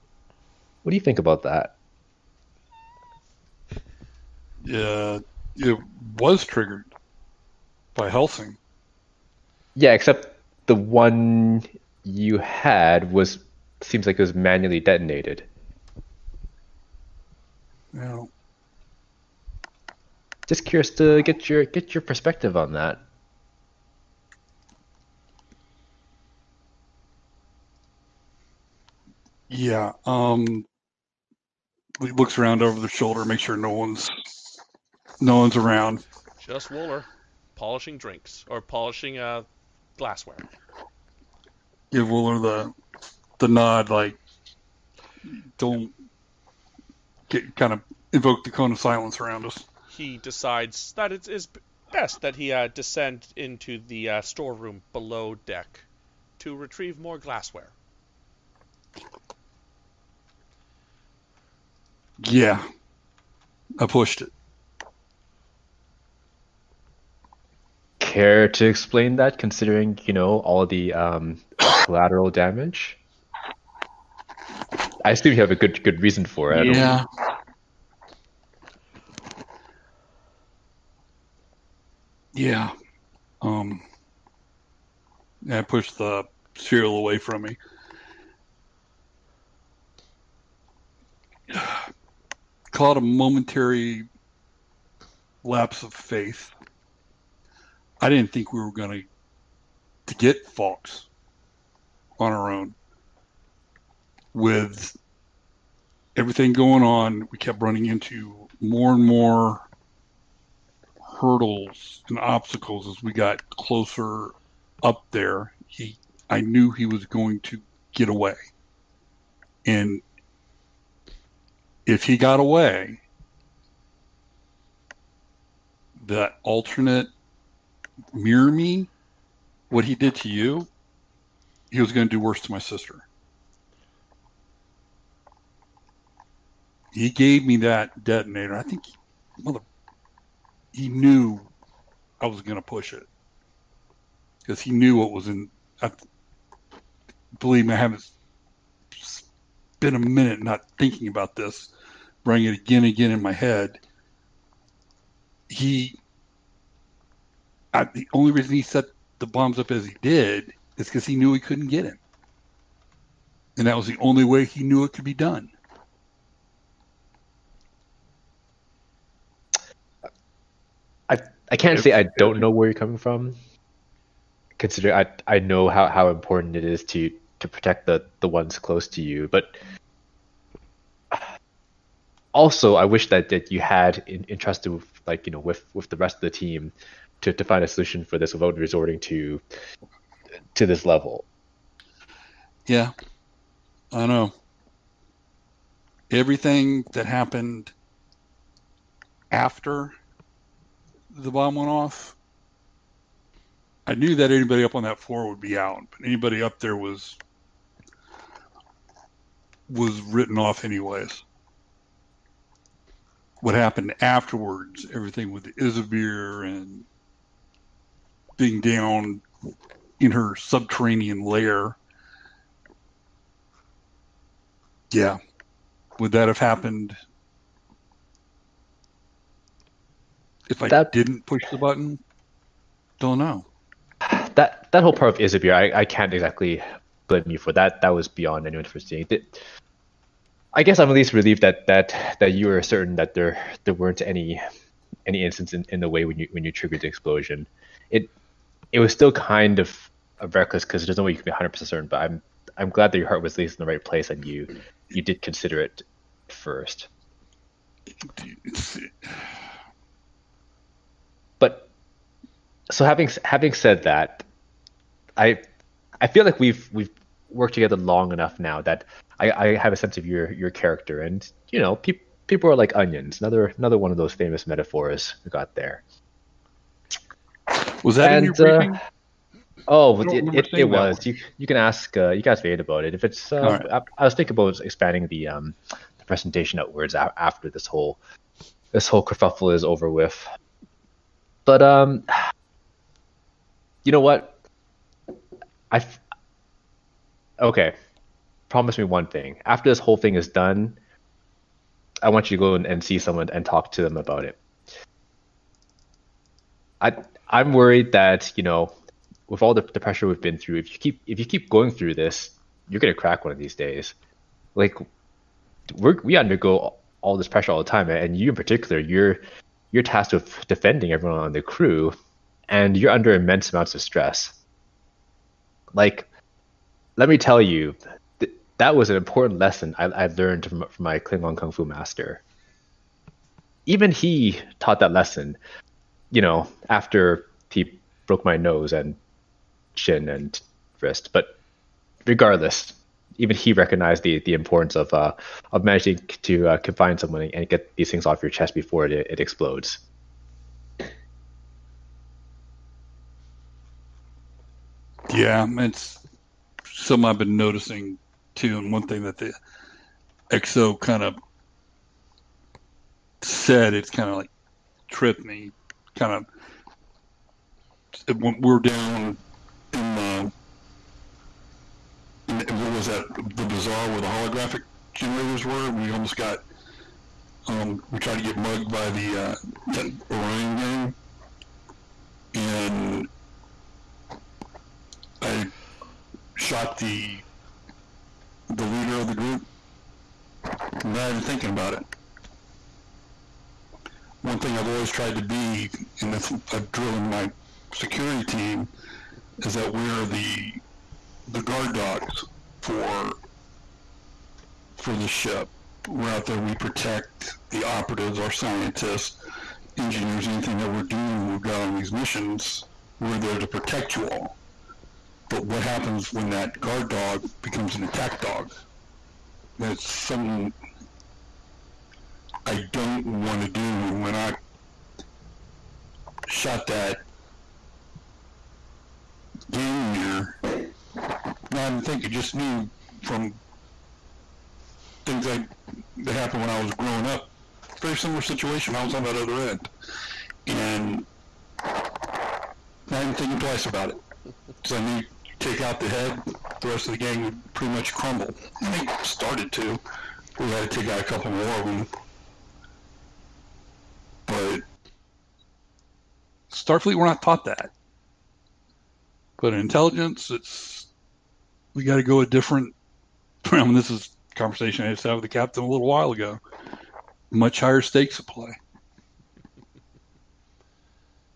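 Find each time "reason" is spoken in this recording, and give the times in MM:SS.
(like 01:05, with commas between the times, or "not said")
01:16, 02:38.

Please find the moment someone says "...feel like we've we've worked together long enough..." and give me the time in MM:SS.
04:26.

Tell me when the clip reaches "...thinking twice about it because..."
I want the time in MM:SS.
07:23.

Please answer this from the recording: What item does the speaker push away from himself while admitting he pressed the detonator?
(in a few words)
The cereal.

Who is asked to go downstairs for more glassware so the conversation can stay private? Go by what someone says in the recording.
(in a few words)
Wooler.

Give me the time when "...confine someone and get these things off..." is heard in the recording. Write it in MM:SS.
05:46.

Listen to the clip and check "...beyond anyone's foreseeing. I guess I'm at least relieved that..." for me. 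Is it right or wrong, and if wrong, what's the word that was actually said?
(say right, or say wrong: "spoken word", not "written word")
right.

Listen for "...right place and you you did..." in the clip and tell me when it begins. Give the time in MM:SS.
04:13.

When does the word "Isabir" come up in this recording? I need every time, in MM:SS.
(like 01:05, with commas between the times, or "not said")
03:35, 03:55.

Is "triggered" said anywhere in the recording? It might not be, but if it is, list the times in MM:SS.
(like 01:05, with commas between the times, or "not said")
00:06, 04:06.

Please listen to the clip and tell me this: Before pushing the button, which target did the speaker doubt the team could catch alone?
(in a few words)
Fox.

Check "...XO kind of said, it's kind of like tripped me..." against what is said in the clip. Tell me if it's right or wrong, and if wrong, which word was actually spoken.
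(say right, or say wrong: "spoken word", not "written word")
right.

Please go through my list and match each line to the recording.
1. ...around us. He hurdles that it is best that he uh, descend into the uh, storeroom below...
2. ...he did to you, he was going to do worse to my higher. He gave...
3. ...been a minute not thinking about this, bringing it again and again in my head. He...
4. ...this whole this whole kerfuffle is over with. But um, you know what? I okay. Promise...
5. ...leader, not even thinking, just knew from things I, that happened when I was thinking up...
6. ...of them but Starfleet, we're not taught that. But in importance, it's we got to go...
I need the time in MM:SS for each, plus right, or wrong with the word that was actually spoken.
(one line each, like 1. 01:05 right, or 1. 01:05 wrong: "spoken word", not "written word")
1. 00:49 wrong: "decides", not "hurdles"
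2. 02:09 wrong: "sister", not "higher"
3. 02:29 right
4. 04:47 right
5. 07:09 wrong: "growing", not "thinking"
6. 07:31 wrong: "intelligence", not "importance".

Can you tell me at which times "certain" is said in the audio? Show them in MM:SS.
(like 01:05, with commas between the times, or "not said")
04:02, 04:11.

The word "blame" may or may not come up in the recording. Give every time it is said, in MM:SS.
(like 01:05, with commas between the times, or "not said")
03:57.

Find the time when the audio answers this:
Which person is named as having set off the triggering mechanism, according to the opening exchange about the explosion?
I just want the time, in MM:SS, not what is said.
00:08.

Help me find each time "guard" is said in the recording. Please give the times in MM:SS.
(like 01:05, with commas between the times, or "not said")
06:41, 06:56.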